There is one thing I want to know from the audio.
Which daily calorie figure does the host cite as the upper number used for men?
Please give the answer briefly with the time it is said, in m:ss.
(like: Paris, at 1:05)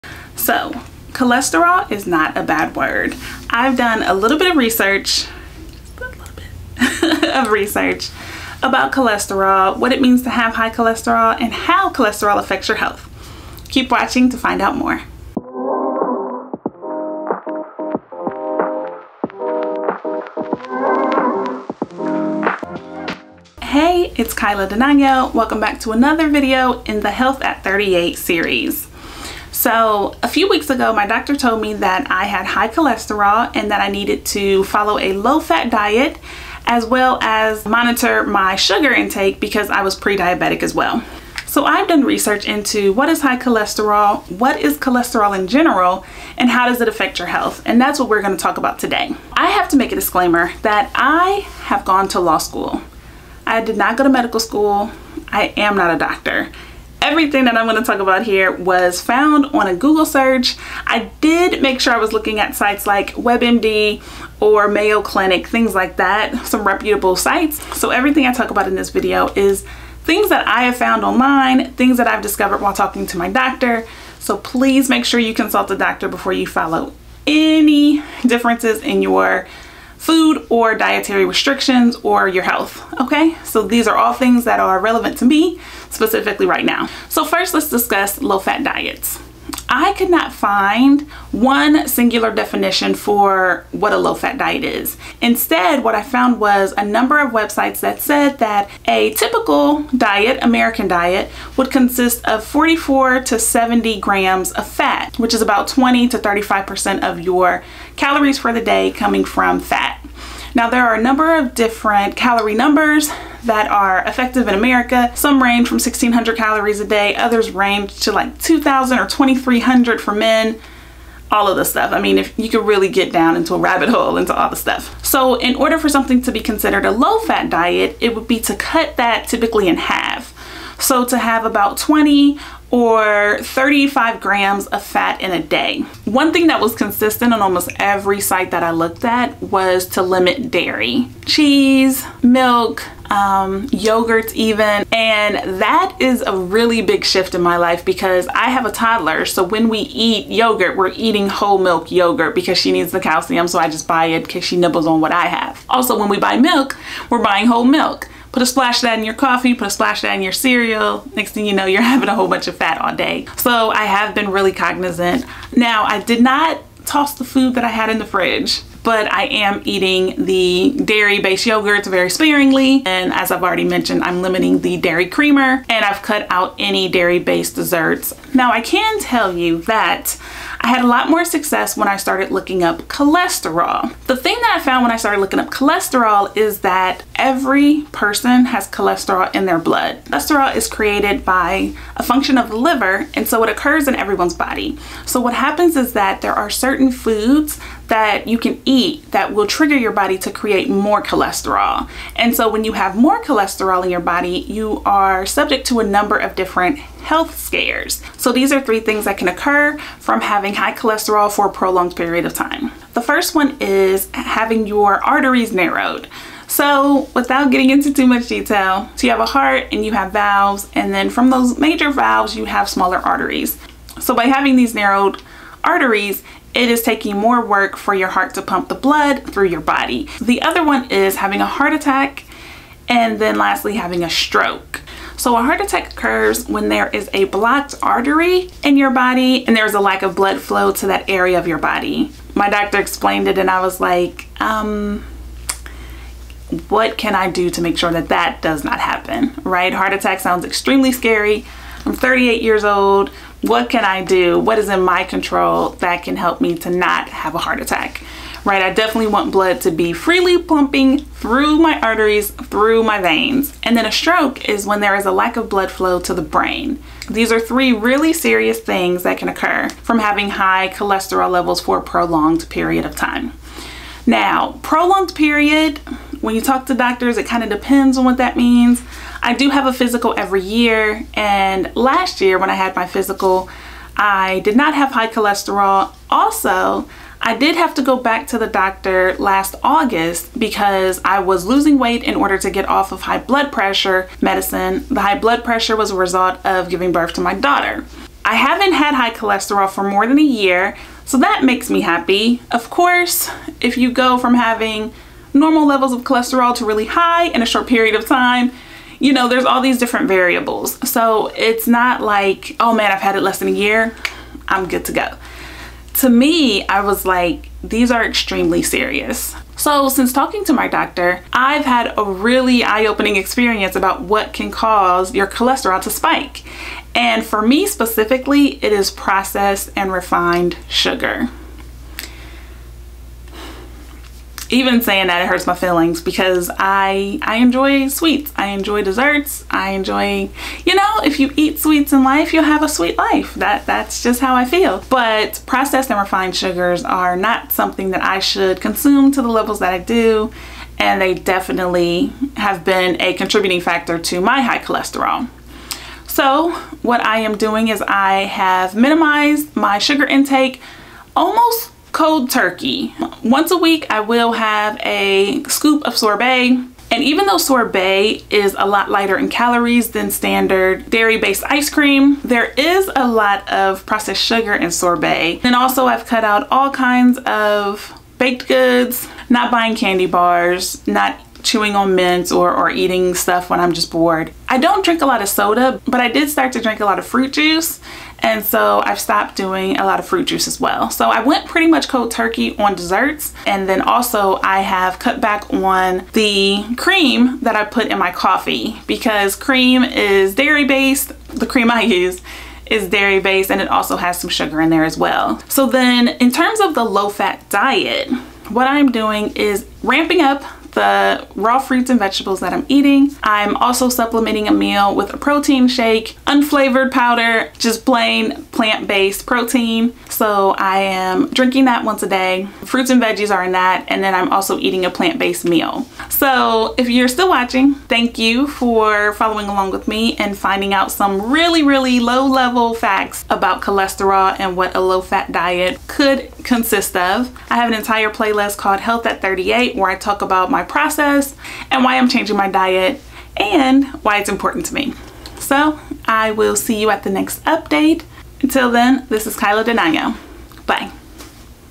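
2300, at 1:59.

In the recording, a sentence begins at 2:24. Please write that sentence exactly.
And that is a really big shift in my life because I have a toddler.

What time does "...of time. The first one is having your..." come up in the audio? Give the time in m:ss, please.
3:32.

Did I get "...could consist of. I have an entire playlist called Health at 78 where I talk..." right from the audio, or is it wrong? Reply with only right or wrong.
wrong.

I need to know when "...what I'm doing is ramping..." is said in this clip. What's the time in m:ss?
6:48.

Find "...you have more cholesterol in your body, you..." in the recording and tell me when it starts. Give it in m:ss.
3:22.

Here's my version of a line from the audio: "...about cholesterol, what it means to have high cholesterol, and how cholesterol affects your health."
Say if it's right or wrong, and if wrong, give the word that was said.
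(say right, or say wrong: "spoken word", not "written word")
right.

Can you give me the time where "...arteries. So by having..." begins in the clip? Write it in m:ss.
3:42.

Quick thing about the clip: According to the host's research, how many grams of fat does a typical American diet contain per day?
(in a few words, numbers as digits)
44 to 70 grams.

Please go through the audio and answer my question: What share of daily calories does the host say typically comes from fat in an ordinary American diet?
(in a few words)
20 to 35%.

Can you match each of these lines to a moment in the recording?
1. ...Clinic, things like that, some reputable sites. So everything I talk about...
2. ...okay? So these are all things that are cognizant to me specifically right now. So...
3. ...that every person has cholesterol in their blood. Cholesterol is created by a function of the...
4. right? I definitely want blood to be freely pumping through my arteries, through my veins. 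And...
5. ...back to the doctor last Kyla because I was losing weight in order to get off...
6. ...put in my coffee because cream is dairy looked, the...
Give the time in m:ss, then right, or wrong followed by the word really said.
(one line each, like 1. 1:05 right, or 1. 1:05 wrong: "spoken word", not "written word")
1. 1:05 right
2. 1:22 wrong: "relevant", not "cognizant"
3. 3:06 right
4. 4:18 right
5. 4:47 wrong: "August", not "Kyla"
6. 6:37 wrong: "based", not "looked".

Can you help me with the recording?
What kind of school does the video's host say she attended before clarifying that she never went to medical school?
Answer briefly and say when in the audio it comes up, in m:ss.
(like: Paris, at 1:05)
law school, at 0:52.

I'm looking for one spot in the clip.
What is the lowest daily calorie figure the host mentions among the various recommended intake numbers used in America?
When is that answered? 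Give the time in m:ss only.
1:55.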